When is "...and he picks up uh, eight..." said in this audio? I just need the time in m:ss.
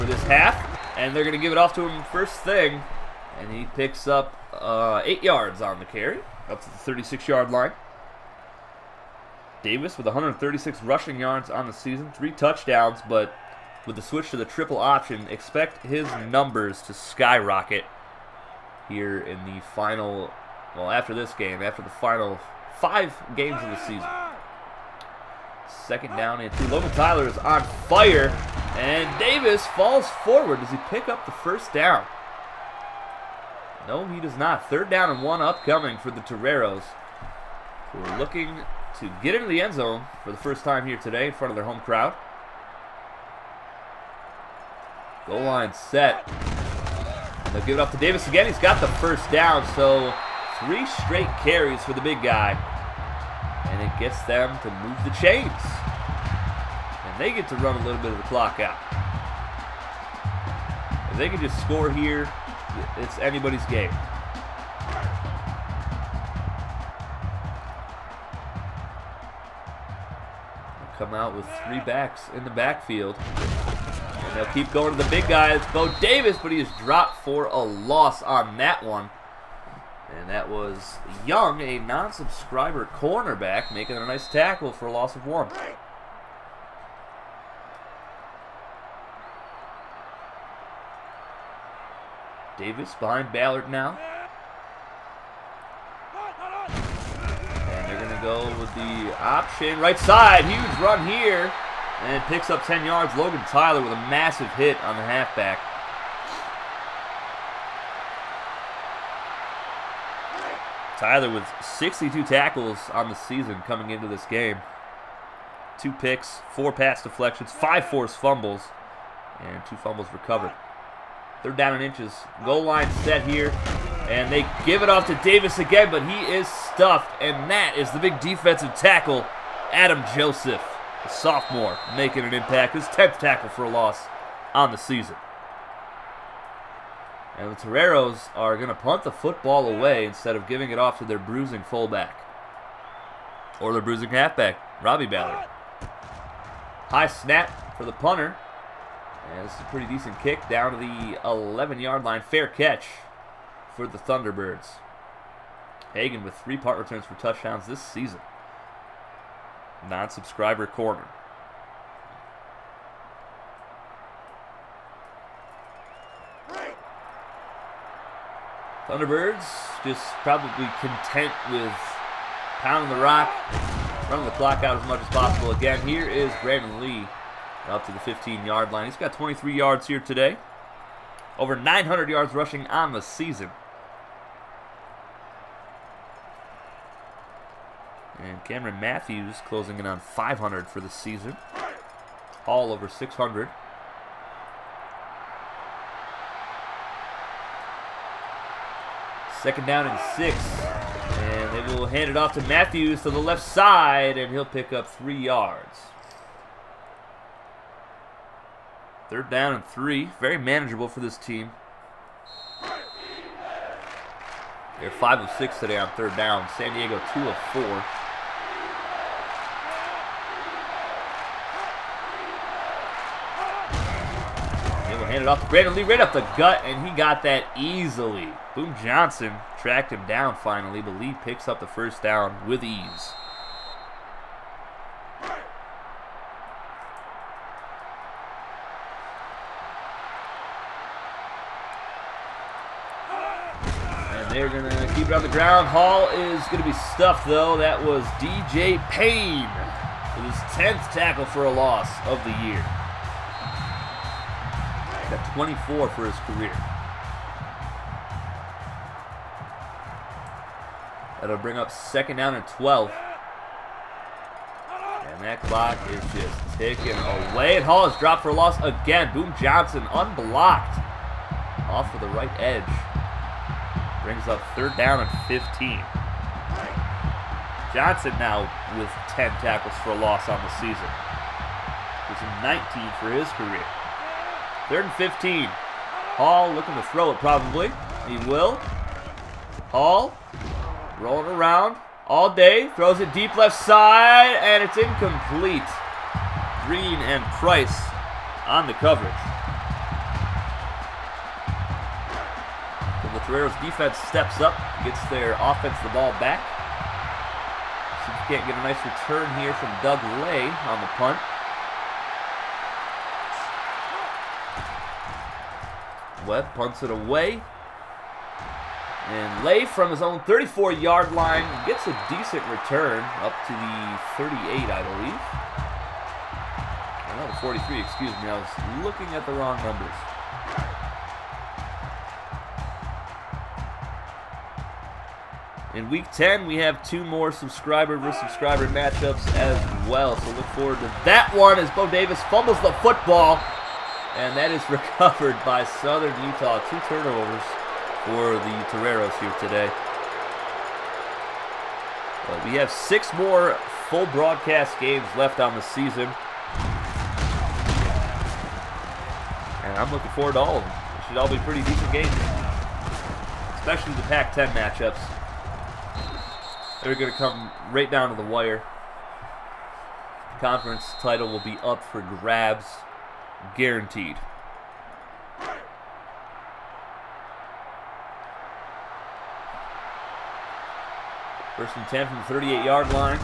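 0:03.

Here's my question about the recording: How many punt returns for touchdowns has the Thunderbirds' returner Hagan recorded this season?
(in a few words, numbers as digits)
3.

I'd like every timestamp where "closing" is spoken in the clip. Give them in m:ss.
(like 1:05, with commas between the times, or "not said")
3:09.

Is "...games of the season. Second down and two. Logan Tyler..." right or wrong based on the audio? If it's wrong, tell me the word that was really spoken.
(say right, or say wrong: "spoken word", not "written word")
right.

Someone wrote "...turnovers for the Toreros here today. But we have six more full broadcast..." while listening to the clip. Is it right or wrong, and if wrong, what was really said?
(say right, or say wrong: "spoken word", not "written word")
right.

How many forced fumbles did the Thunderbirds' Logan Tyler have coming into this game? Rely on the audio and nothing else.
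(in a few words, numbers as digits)
5.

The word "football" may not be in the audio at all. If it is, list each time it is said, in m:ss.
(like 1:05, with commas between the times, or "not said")
2:19, 5:42.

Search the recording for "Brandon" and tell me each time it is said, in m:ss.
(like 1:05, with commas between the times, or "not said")
2:56, 3:45.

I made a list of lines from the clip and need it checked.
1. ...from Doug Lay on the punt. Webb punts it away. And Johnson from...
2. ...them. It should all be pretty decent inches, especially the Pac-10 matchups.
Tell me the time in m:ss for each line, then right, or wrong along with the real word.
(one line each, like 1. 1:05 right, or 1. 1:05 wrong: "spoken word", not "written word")
1. 5:09 wrong: "Lay", not "Johnson"
2. 6:00 wrong: "games", not "inches".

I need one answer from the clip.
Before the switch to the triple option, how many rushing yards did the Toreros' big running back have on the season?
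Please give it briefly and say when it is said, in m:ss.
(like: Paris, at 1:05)
136, at 0:10.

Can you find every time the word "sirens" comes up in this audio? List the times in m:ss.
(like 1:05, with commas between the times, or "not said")
not said.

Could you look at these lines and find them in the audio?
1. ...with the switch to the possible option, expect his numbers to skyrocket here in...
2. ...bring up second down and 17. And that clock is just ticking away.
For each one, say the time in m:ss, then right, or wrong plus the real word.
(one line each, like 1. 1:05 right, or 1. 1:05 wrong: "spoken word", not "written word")
1. 0:13 wrong: "triple", not "possible"
2. 4:21 wrong: "12", not "17".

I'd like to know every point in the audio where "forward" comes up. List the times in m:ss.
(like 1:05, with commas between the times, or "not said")
0:30, 5:40, 6:00.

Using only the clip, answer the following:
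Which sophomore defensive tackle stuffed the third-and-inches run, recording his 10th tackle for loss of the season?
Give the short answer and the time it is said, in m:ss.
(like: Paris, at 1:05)
Adam Joseph, at 2:09.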